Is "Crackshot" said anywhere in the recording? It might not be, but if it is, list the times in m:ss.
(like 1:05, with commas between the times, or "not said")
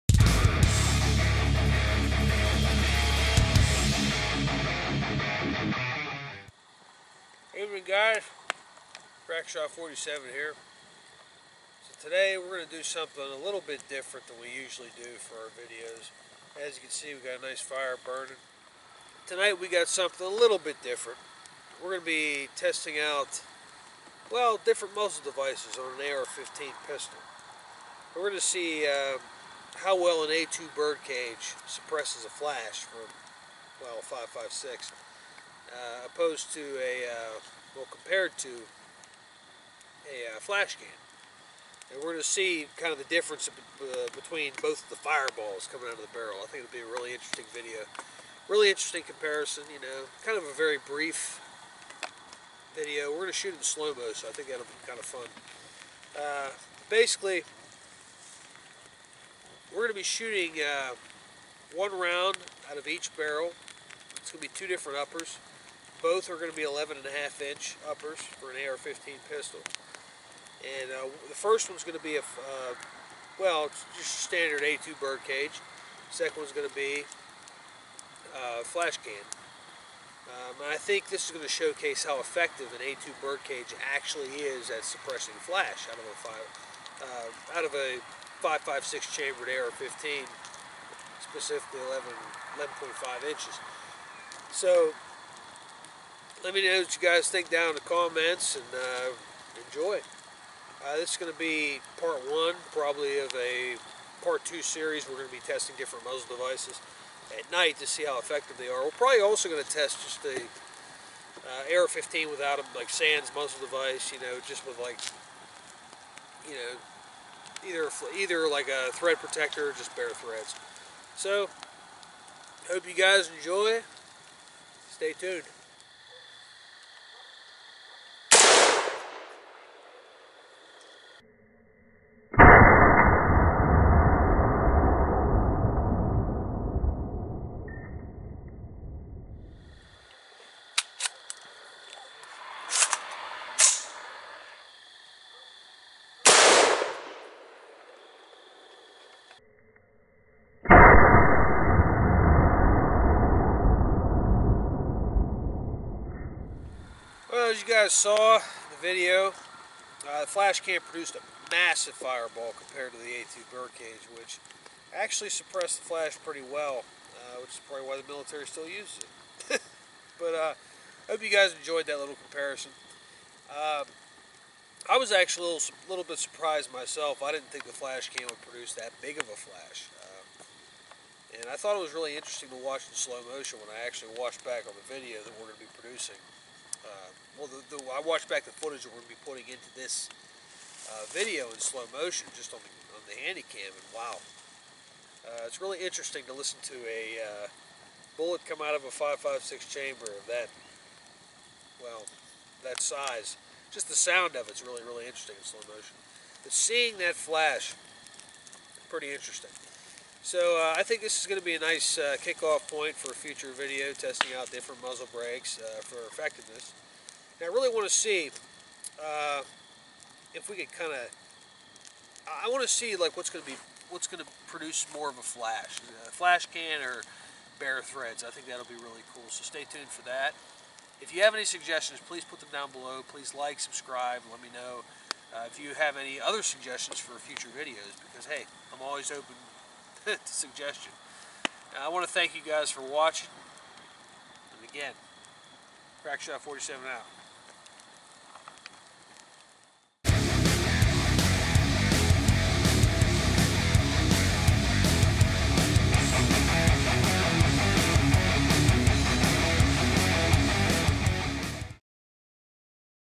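0:09, 4:06.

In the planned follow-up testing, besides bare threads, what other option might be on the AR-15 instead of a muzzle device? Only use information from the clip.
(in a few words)
Thread protector.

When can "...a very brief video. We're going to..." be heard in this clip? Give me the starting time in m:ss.
0:50.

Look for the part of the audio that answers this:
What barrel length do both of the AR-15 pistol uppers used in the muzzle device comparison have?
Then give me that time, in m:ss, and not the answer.
1:06.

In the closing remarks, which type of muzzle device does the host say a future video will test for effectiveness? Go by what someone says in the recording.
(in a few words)
Muzzle brakes.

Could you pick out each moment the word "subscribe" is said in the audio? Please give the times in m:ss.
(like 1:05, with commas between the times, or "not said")
3:53.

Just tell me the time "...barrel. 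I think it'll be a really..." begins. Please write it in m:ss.
0:46.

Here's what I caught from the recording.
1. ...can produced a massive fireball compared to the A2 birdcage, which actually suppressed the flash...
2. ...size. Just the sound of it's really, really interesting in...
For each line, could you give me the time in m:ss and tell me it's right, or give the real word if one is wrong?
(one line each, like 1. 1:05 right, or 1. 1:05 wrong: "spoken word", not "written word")
1. 2:40 right
2. 3:22 right.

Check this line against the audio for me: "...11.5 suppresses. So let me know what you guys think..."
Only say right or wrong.
wrong.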